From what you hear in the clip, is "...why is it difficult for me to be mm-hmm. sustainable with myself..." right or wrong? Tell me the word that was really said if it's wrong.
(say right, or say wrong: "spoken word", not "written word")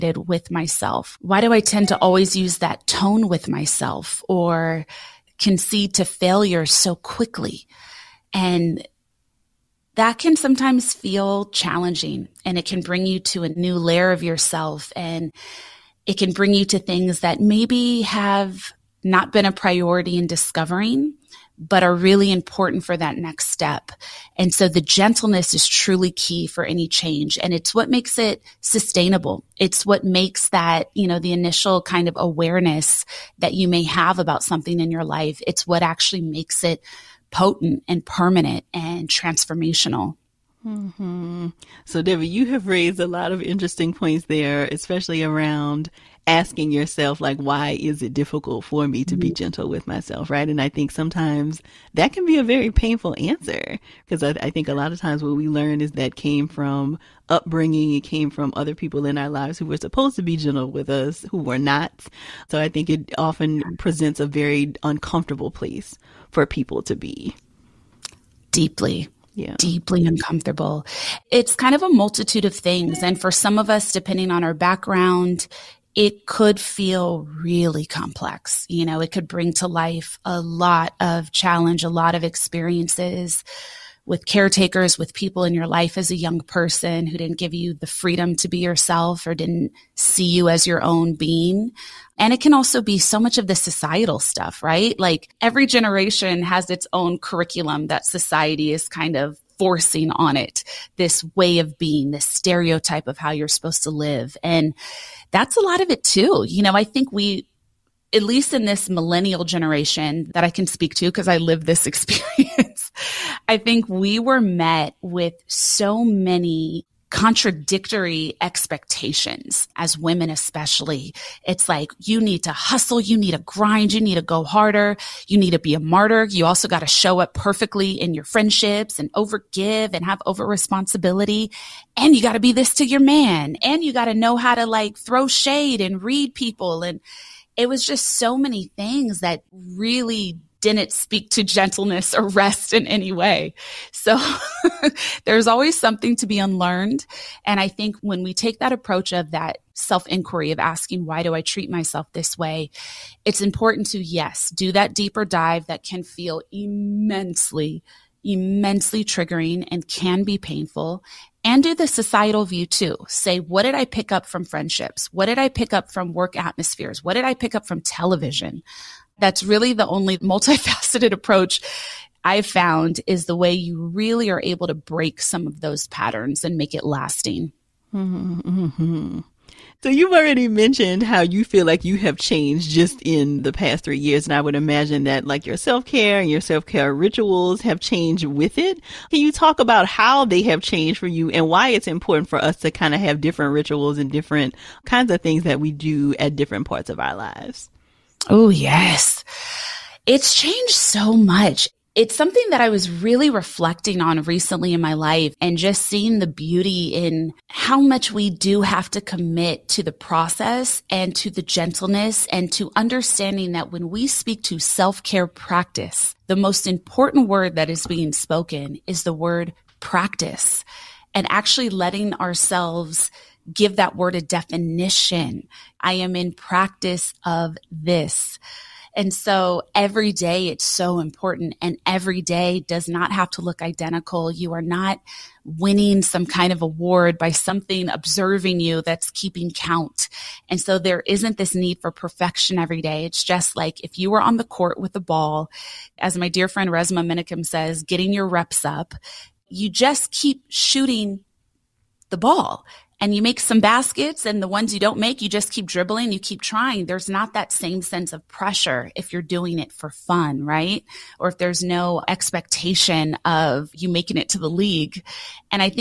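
wrong: "gentle", not "sustainable".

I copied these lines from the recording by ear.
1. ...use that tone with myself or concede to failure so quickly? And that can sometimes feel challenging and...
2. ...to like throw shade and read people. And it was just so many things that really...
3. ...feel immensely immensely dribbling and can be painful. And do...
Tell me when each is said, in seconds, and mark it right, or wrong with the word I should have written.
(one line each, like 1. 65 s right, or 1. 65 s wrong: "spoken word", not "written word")
1. 2 s right
2. 134 s right
3. 156 s wrong: "triggering", not "dribbling".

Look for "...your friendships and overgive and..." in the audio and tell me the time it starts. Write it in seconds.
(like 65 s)
128 s.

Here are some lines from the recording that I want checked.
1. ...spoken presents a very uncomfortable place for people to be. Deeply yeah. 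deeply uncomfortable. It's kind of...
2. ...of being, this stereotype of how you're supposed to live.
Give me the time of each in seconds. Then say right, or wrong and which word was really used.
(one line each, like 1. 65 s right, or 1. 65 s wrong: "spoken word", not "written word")
1. 63 s wrong: "often", not "spoken"
2. 101 s right.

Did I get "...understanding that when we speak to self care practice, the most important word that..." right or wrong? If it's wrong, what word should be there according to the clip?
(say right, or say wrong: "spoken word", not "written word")
right.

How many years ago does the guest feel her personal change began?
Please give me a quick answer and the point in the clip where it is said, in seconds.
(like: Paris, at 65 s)
3, at 183 s.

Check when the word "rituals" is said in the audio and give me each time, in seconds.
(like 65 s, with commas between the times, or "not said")
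186 s, 193 s.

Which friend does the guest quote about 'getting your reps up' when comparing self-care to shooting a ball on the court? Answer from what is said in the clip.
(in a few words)
Resmaa Menakem.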